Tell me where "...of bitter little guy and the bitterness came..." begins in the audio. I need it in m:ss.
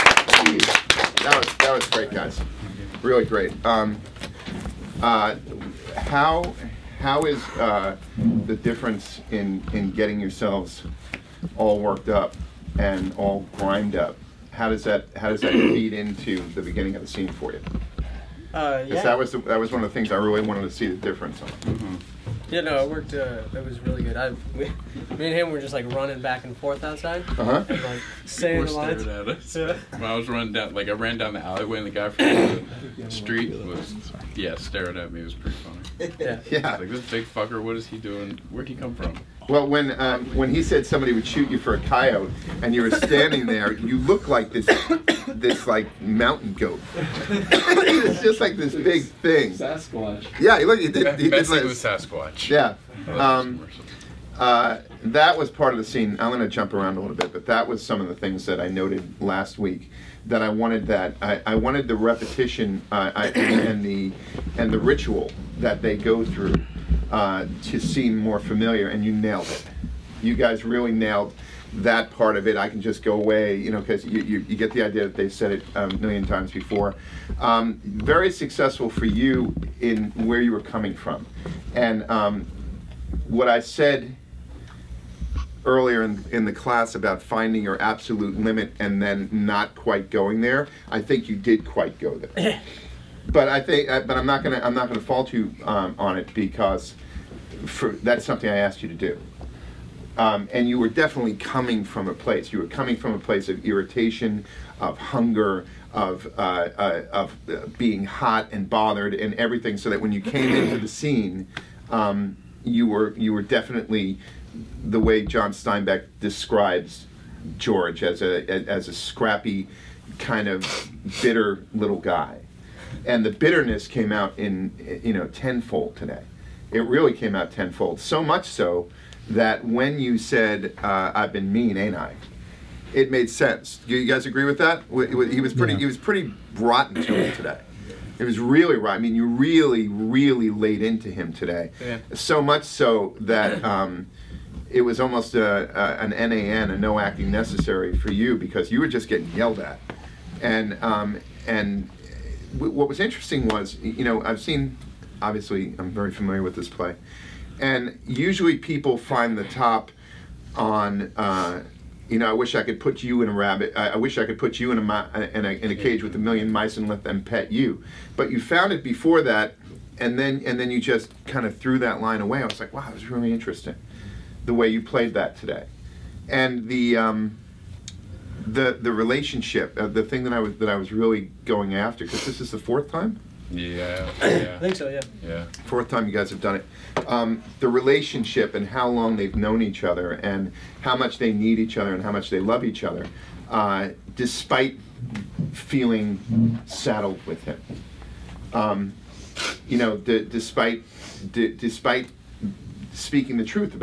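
2:00.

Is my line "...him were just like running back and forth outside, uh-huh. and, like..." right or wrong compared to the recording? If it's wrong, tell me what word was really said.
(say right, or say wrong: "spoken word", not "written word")
right.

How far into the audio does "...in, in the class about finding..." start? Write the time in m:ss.
1:26.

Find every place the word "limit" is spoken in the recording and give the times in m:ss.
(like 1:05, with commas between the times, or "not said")
1:28.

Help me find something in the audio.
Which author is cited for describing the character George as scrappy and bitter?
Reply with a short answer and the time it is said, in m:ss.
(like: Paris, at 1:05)
John Steinbeck, at 1:55.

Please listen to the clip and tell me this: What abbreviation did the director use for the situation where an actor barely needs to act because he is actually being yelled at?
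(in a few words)
NAN.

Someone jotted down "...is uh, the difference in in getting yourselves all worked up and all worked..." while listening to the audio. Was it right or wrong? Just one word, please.
wrong.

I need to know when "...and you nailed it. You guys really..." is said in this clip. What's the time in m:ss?
1:08.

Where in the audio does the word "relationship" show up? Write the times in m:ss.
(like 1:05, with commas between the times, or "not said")
2:58, 3:07.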